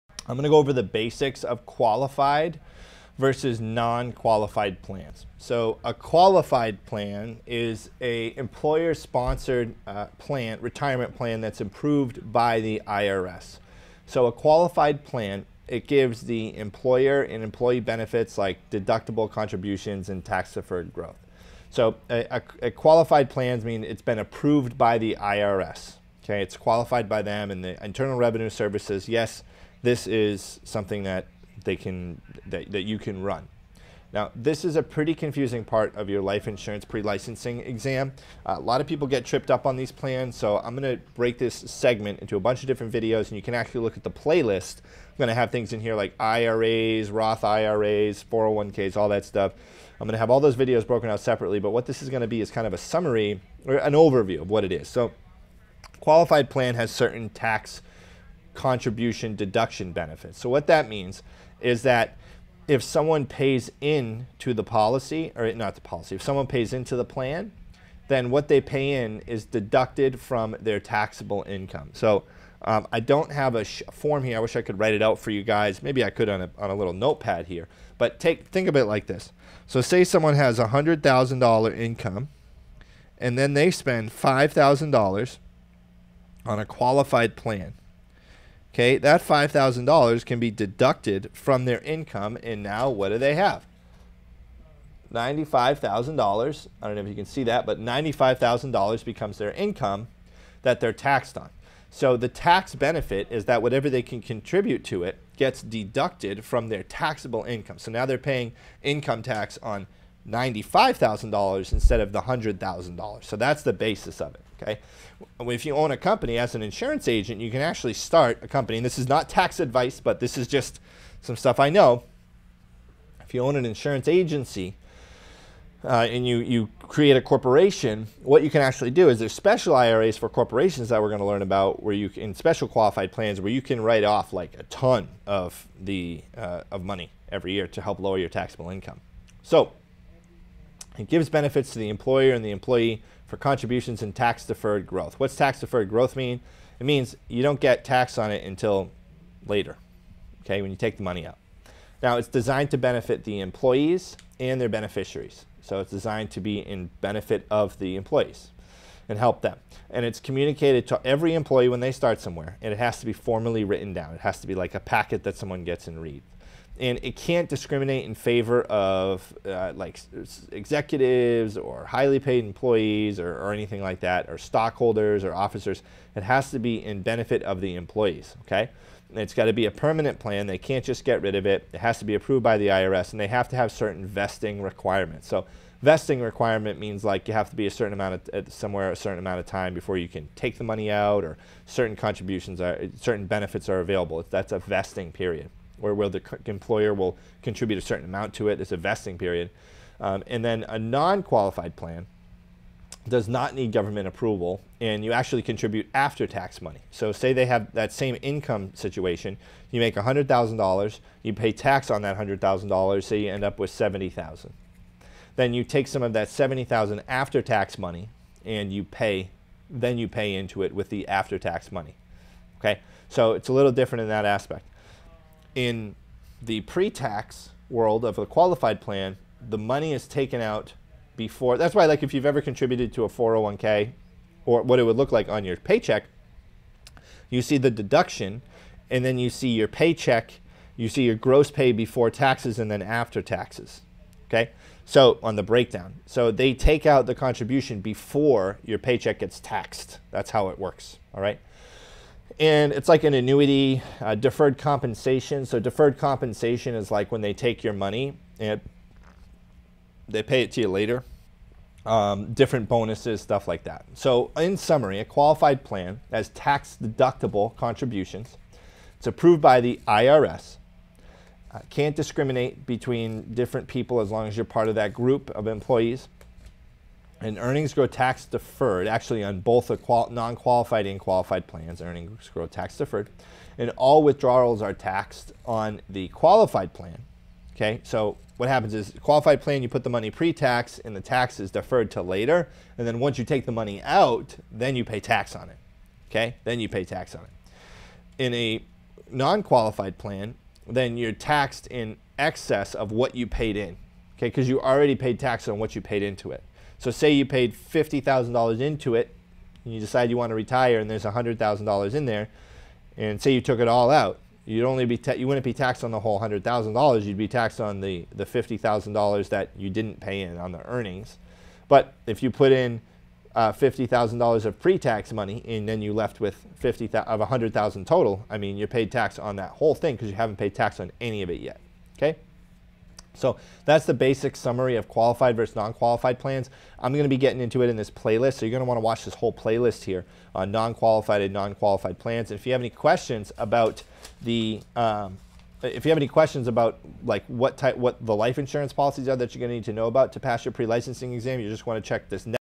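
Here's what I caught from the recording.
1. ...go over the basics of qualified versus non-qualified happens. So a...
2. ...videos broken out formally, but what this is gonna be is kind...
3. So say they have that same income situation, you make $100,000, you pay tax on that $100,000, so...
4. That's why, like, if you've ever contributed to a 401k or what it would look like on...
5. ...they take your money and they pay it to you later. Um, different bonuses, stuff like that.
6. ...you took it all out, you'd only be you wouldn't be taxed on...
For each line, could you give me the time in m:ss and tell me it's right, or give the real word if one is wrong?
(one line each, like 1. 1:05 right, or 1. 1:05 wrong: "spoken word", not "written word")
1. 0:00 wrong: "plans", not "happens"
2. 0:50 wrong: "separately", not "formally"
3. 3:26 right
4. 3:51 right
5. 4:17 right
6. 5:13 right.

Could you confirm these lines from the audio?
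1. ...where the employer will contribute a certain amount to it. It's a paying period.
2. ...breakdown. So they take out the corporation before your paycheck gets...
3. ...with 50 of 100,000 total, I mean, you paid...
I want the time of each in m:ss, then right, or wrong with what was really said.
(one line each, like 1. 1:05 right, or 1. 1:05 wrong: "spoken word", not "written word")
1. 3:15 wrong: "vesting", not "paying"
2. 4:05 wrong: "contribution", not "corporation"
3. 5:26 right.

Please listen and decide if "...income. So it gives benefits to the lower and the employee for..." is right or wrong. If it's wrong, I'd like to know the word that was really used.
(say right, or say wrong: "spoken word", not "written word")
wrong: "employer", not "lower".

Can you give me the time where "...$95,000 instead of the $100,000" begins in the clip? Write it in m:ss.
1:50.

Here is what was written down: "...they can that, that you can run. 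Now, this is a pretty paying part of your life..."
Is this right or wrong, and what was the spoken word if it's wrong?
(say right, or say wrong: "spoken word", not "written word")
wrong: "confusing", not "paying".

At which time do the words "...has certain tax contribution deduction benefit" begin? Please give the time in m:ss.
0:56.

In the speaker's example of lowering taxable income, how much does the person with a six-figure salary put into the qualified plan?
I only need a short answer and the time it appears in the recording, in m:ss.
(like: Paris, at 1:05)
$5,000, at 1:24.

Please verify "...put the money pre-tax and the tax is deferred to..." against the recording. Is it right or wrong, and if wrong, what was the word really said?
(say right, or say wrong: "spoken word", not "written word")
right.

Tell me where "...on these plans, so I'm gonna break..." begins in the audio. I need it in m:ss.
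0:39.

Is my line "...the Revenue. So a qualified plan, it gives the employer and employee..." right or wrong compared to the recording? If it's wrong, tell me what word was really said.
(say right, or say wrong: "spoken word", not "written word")
wrong: "IRS", not "Revenue".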